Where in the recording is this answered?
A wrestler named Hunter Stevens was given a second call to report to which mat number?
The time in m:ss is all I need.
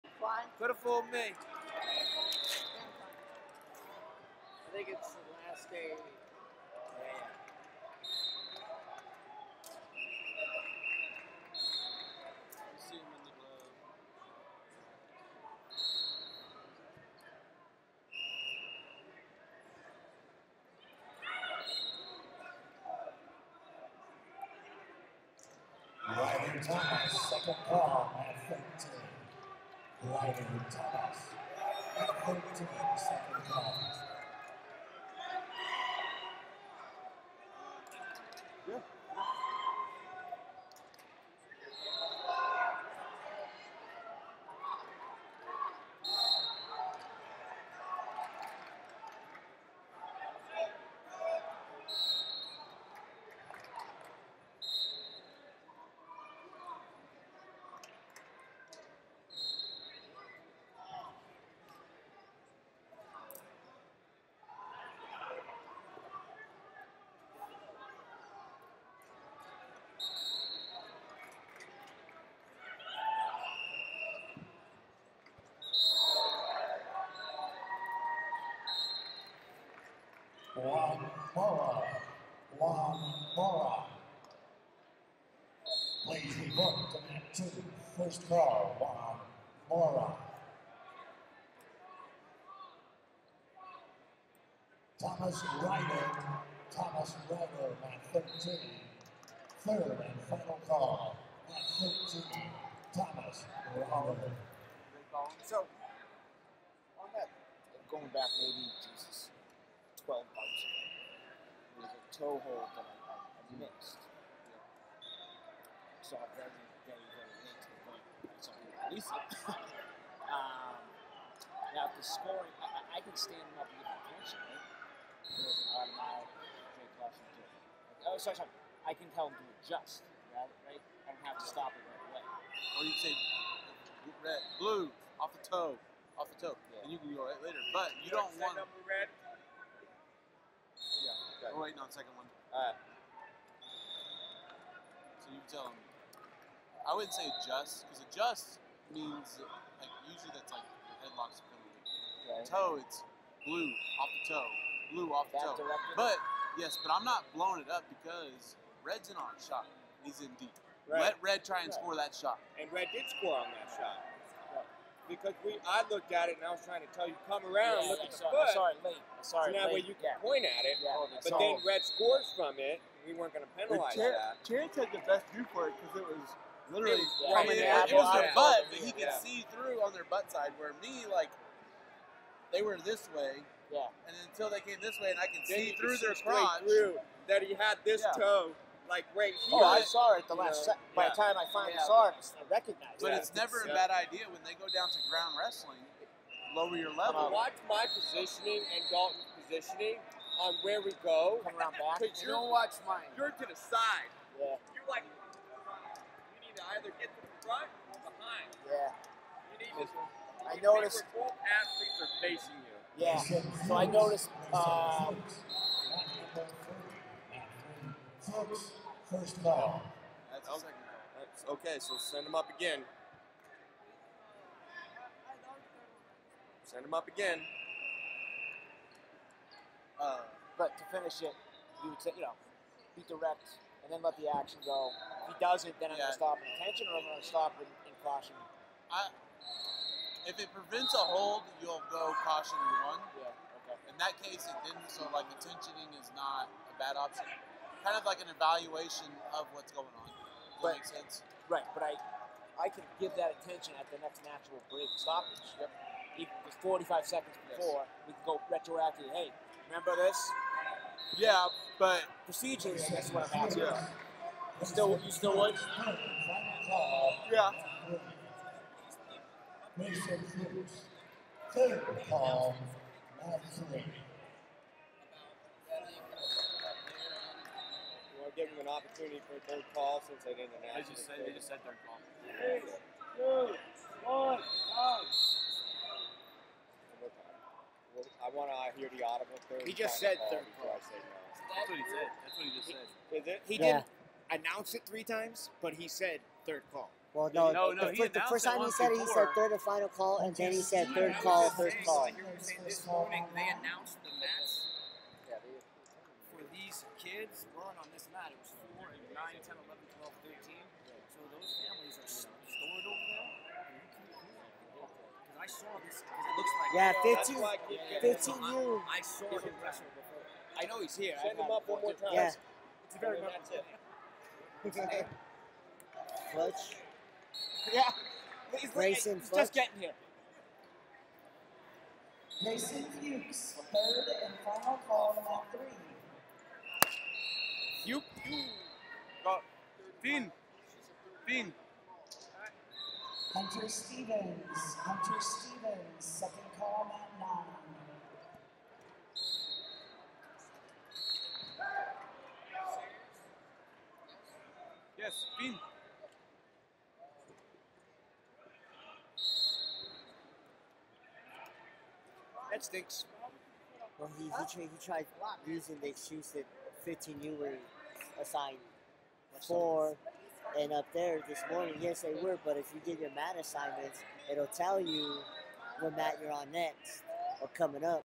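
5:46.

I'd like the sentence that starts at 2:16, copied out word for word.
and you can go right later.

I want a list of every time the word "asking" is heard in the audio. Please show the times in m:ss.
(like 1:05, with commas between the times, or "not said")
4:23.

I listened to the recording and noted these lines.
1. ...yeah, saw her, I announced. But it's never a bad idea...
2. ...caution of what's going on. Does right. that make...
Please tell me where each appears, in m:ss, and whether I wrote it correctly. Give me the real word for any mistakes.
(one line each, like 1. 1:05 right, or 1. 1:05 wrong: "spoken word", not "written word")
1. 3:11 wrong: "recognized", not "announced"
2. 4:08 wrong: "evaluation", not "caution".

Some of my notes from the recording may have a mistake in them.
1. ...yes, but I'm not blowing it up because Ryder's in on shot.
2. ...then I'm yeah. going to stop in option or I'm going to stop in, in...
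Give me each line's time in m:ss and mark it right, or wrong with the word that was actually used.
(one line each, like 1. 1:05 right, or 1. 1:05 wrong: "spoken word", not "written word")
1. 2:36 wrong: "Red", not "Ryder"
2. 3:55 wrong: "attention", not "option".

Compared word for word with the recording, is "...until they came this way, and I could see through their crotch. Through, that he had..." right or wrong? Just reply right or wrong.
right.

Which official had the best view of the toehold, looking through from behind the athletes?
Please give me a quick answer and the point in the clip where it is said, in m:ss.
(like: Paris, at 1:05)
Chance, at 2:54.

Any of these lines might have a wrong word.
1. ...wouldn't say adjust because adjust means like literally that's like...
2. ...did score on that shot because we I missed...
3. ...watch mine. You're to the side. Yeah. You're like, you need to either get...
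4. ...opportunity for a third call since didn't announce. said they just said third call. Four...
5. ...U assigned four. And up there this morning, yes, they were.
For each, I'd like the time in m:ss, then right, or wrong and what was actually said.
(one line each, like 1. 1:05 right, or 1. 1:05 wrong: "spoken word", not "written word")
1. 2:26 wrong: "usually", not "literally"
2. 2:42 wrong: "looked", not "missed"
3. 3:22 right
4. 4:38 wrong: "Three", not "Four"
5. 6:07 right.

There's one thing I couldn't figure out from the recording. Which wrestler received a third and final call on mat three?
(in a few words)
Mason Fuchs.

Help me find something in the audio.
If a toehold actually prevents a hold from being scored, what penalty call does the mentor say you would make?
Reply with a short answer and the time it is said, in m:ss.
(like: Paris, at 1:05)
caution one, at 4:01.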